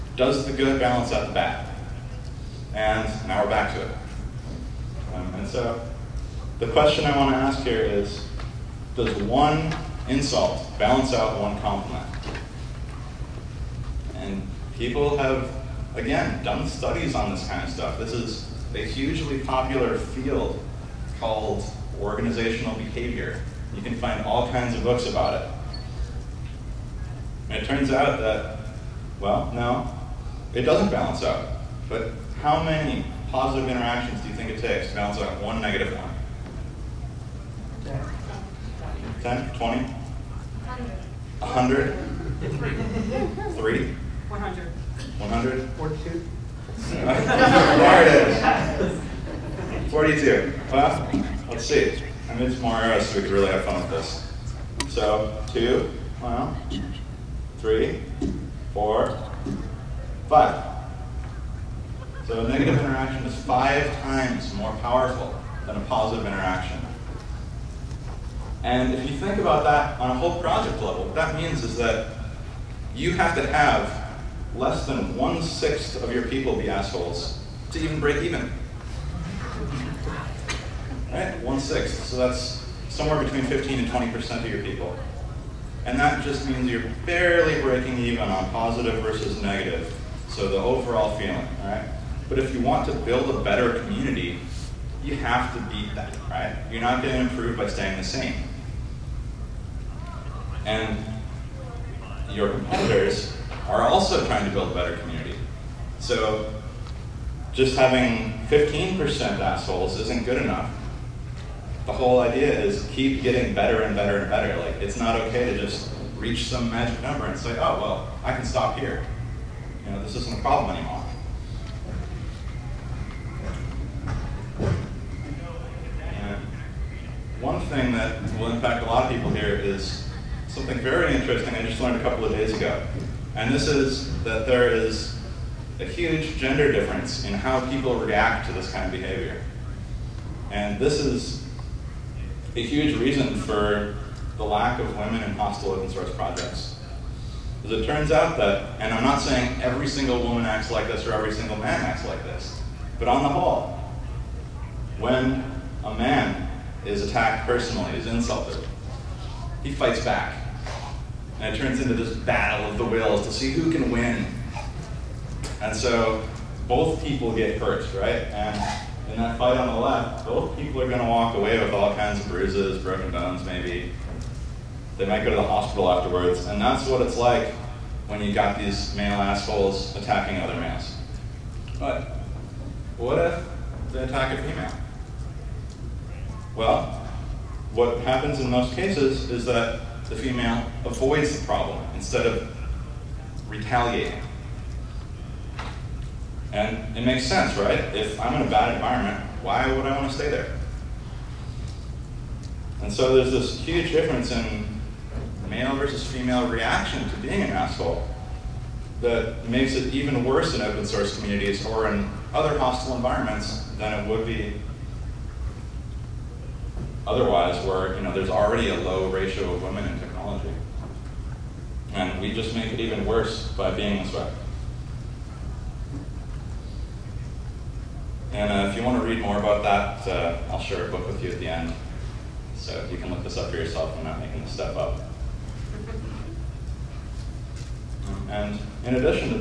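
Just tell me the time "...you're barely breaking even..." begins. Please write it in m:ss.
1:26.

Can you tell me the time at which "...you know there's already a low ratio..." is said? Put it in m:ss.
3:37.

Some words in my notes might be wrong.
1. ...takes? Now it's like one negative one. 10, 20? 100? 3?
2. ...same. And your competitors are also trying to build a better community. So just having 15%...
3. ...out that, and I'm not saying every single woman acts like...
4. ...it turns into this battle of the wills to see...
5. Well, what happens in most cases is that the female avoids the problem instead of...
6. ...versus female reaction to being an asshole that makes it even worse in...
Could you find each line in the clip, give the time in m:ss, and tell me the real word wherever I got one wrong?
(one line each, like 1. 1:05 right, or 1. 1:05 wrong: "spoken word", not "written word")
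1. 0:34 right
2. 1:38 right
3. 2:28 right
4. 2:41 right
5. 3:06 right
6. 3:25 right.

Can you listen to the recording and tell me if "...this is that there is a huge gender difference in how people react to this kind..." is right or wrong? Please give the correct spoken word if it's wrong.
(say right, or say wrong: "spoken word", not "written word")
right.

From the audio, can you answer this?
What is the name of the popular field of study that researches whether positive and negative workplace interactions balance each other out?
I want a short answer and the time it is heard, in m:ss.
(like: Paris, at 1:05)
Organizational behavior, at 0:21.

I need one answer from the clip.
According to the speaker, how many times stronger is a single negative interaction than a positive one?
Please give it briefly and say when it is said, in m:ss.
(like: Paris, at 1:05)
5 times, at 1:03.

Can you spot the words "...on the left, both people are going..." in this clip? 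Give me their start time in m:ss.
2:49.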